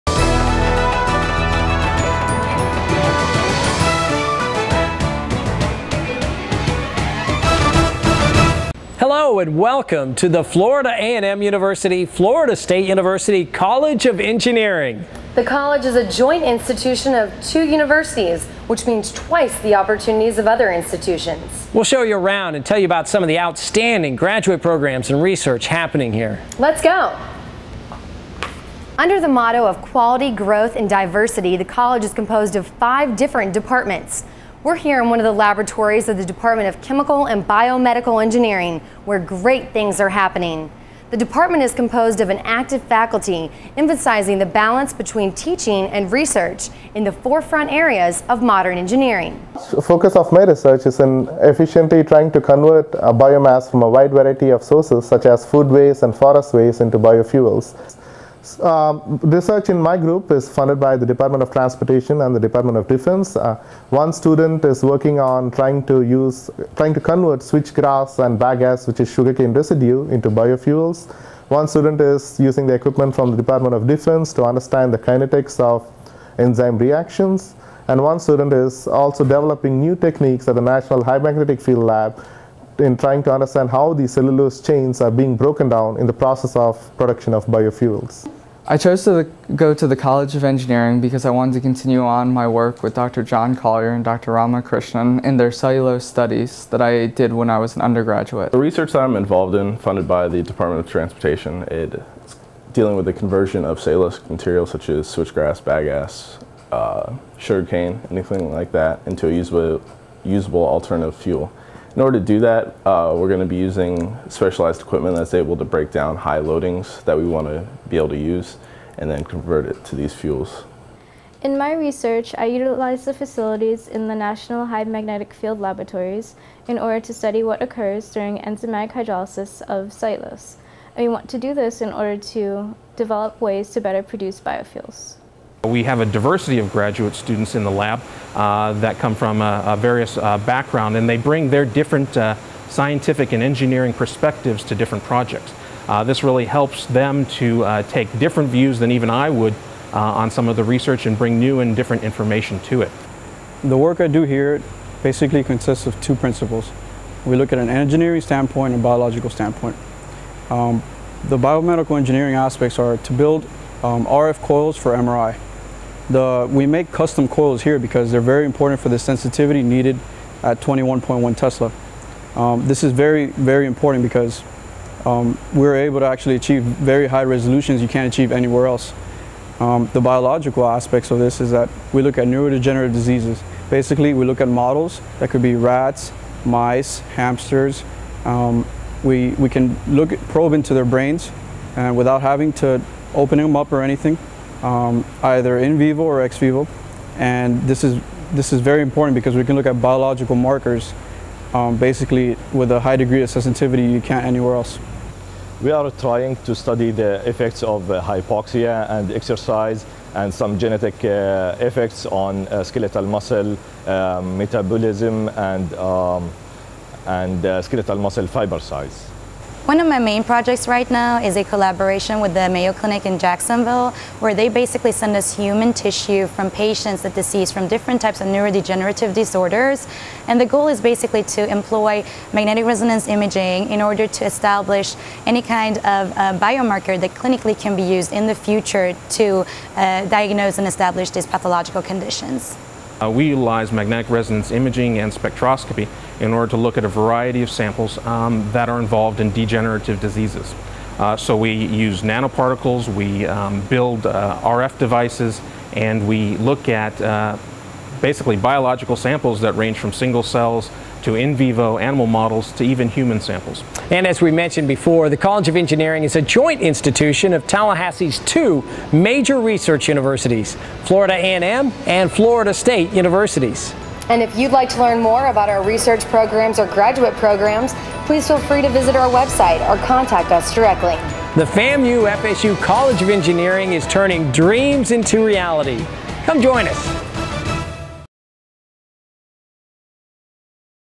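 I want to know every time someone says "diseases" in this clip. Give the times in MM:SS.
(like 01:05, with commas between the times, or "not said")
03:02, 03:47, 04:09.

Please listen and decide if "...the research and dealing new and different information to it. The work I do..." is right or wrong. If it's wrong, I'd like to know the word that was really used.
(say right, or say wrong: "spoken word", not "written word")
wrong: "bring", not "dealing".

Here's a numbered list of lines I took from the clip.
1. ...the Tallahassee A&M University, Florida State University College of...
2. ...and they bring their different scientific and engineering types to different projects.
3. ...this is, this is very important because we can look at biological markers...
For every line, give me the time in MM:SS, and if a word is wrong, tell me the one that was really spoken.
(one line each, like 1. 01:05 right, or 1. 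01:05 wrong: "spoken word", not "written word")
1. 00:10 wrong: "Florida", not "Tallahassee"
2. 02:20 wrong: "perspectives", not "types"
3. 03:17 right.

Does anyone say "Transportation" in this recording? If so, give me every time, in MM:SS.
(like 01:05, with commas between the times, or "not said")
01:01, 01:40.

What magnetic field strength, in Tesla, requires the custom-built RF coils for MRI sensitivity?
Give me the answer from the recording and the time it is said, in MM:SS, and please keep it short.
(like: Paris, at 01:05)
21.1 Tesla, at 02:50.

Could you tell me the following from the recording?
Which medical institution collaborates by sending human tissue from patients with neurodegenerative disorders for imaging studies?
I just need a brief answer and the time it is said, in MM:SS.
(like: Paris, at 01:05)
Mayo Clinic, at 03:42.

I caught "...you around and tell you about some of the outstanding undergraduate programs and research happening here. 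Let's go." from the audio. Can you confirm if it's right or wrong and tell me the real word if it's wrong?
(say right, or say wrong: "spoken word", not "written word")
wrong: "graduate", not "undergraduate".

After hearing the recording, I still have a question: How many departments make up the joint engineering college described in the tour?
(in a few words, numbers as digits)
5.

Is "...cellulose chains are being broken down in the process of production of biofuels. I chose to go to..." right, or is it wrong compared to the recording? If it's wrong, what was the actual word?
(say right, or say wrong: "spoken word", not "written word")
right.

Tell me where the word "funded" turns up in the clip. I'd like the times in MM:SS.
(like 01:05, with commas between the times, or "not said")
01:00, 01:39.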